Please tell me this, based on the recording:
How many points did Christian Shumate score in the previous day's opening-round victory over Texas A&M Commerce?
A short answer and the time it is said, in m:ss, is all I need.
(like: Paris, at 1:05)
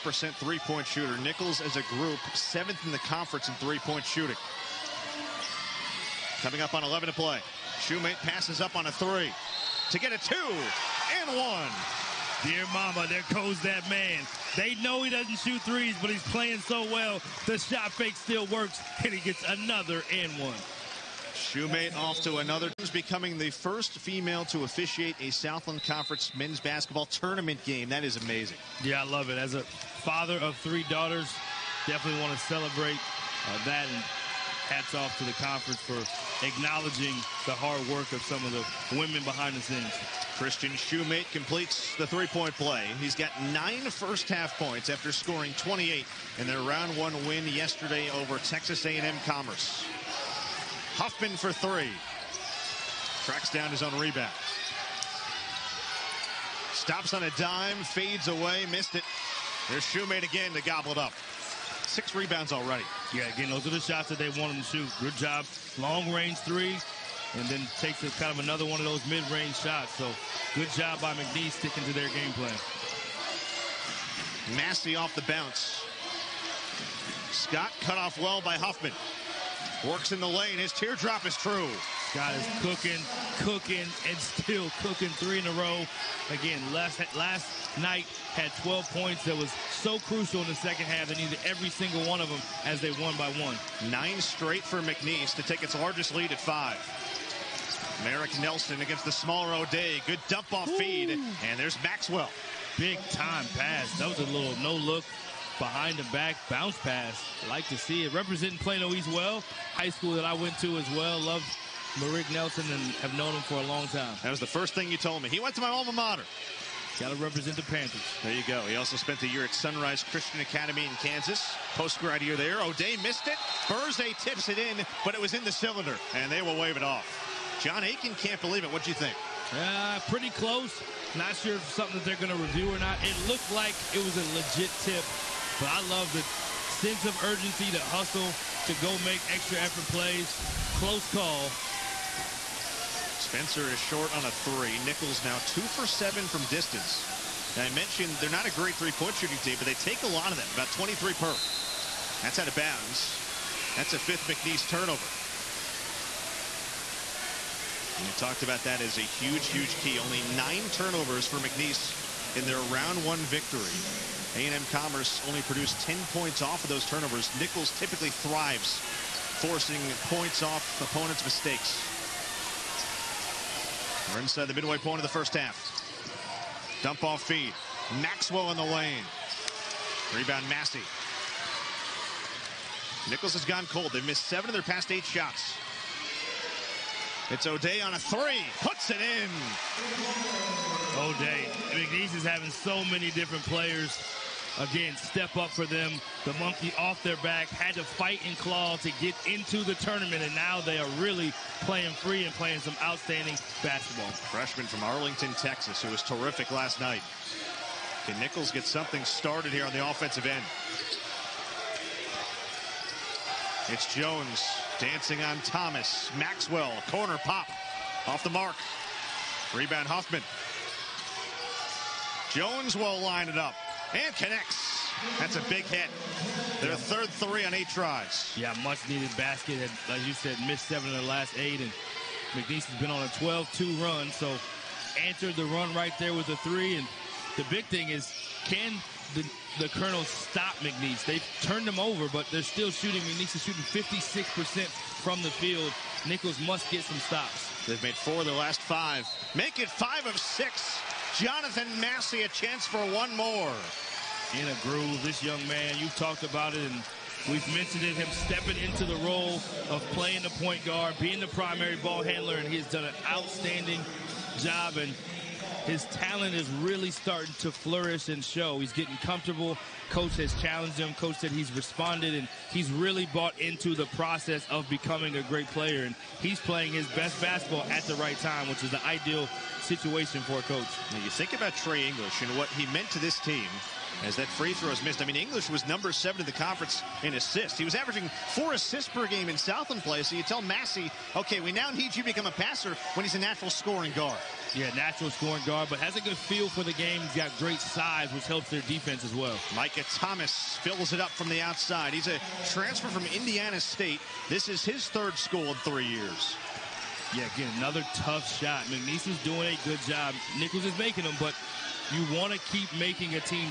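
28, at 0:45.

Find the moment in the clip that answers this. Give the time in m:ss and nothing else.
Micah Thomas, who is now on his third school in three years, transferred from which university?
5:03.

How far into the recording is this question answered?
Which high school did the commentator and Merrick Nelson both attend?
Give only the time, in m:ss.
1:48.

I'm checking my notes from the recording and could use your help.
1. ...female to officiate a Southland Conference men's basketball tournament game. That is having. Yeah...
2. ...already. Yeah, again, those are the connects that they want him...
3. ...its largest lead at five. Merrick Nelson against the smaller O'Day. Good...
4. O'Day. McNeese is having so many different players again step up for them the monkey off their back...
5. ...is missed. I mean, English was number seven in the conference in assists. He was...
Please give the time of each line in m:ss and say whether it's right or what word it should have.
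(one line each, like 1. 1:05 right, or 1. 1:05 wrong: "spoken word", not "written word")
1. 0:23 wrong: "amazing", not "having"
2. 1:02 wrong: "shots", not "connects"
3. 1:35 right
4. 3:10 right
5. 4:44 right.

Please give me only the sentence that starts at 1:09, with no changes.
So good job by McNeese sticking to their game plan.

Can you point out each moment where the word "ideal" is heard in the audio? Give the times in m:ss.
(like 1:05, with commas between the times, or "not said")
4:38.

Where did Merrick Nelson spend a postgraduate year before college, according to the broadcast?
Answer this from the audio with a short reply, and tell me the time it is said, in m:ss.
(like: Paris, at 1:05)
Sunrise Christian Academy, at 1:59.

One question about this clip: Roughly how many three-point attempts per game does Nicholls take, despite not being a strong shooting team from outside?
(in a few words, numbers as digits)
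23.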